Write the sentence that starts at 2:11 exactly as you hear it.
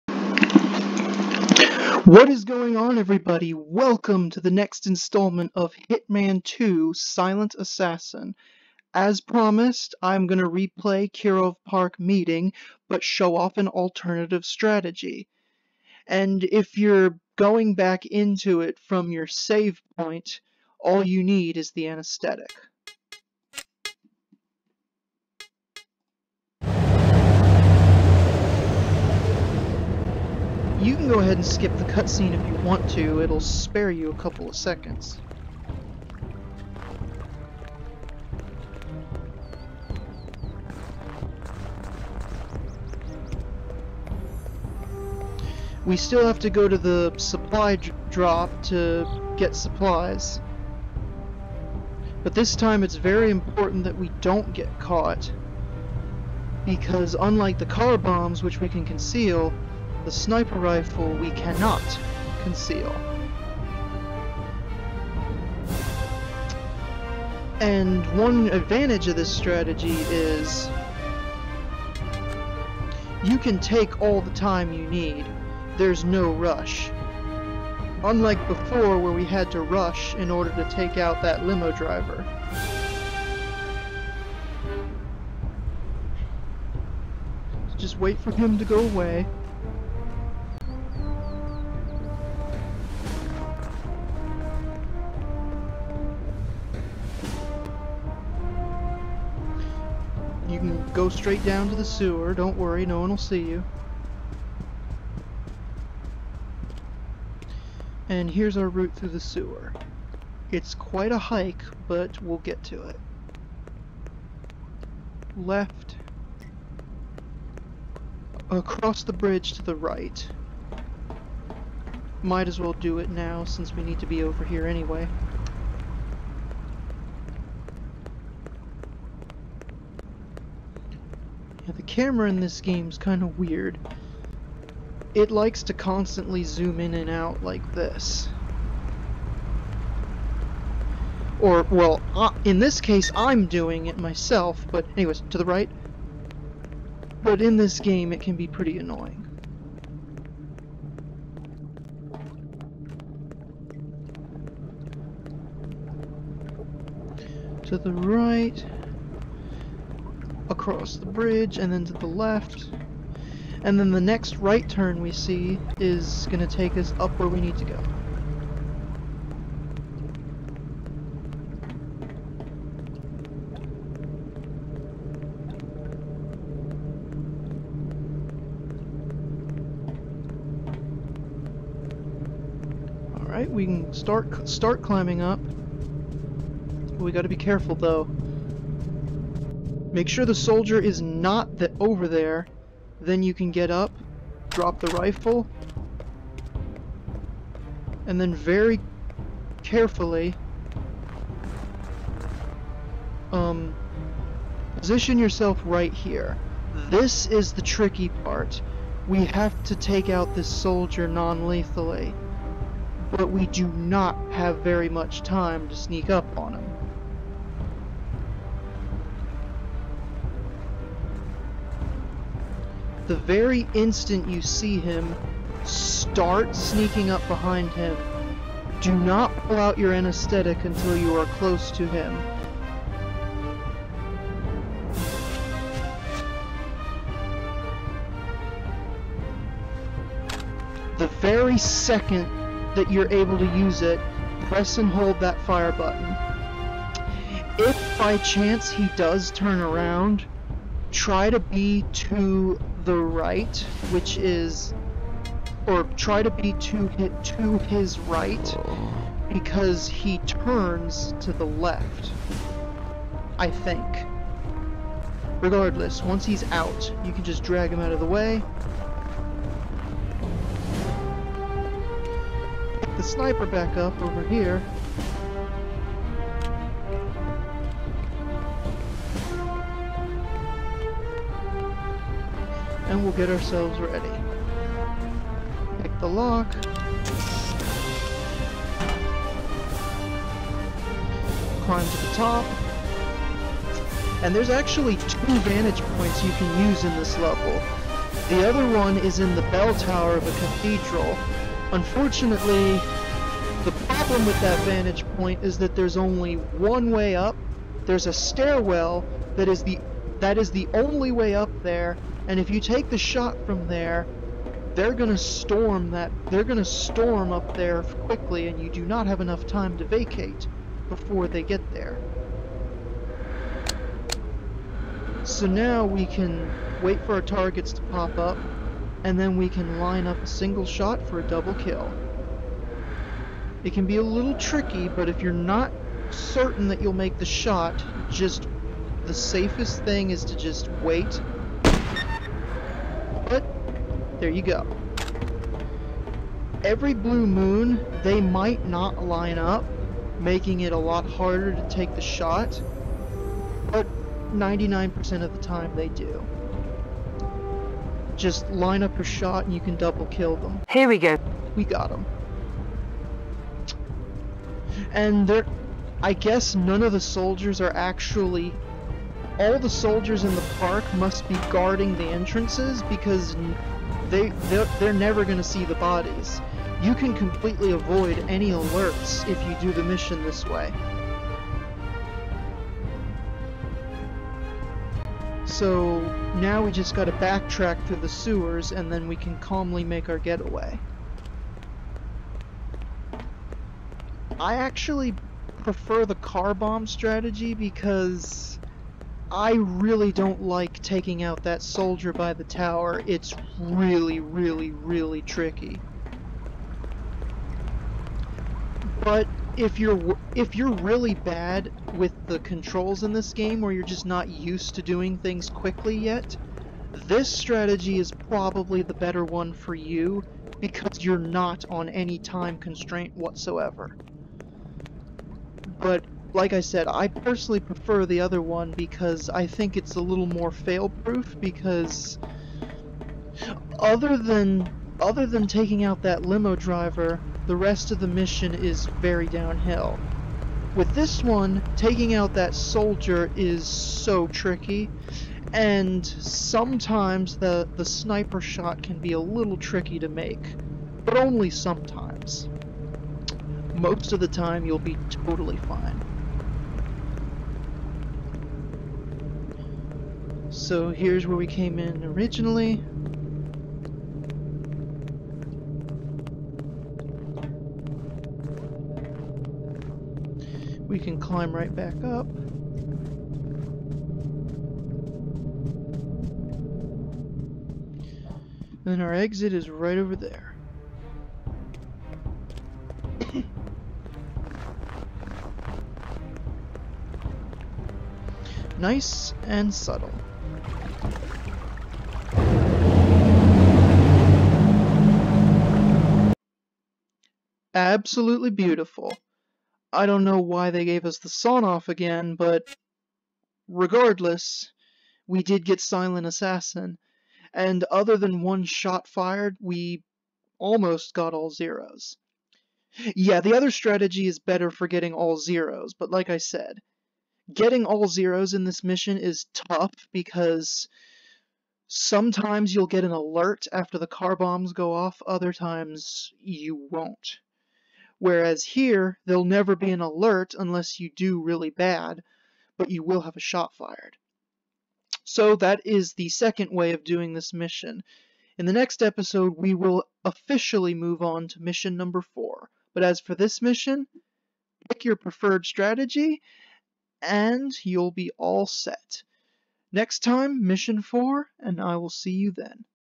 The camera in this game is kind of weird.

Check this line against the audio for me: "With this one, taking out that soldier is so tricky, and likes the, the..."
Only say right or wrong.
wrong.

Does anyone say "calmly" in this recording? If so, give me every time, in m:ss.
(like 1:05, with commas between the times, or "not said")
6:29.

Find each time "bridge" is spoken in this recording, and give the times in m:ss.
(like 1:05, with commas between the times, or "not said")
1:59, 2:41.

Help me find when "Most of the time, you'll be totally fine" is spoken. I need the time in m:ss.
7:33.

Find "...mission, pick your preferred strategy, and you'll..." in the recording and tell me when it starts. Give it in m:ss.
9:03.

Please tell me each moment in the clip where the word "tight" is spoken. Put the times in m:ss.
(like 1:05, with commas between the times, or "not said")
not said.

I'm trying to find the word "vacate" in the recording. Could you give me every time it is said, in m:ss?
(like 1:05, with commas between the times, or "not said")
5:19.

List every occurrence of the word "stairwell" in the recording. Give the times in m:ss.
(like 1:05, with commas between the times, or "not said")
5:08.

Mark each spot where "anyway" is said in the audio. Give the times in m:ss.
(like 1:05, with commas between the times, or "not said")
2:04, 2:24.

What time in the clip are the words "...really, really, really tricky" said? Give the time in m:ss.
6:43.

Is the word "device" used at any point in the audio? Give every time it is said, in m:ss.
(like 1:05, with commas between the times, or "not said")
not said.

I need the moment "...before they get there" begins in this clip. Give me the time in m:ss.
5:20.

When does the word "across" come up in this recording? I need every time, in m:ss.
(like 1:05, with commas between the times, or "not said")
1:58, 2:40.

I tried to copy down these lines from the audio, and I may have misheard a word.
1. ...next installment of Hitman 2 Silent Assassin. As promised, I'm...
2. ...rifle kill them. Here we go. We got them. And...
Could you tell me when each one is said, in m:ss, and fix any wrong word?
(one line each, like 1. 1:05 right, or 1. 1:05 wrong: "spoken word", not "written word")
1. 0:04 right
2. 5:59 wrong: "double", not "rifle".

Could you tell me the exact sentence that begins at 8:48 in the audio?
Whereas here, there'll never be an alert unless you do really bad, but you will have a shot fired.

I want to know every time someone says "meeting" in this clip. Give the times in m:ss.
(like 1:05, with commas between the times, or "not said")
0:11.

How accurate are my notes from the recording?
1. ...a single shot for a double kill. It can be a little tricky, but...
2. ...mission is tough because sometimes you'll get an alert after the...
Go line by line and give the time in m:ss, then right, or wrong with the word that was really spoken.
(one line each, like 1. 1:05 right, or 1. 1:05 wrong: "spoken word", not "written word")
1. 5:30 right
2. 8:38 right.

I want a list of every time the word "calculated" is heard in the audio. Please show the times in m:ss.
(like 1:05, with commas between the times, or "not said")
not said.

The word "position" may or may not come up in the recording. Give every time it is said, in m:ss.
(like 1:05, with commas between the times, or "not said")
3:24.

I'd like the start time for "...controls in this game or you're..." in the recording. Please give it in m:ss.
6:52.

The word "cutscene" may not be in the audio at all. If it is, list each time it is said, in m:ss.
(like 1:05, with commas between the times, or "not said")
0:31.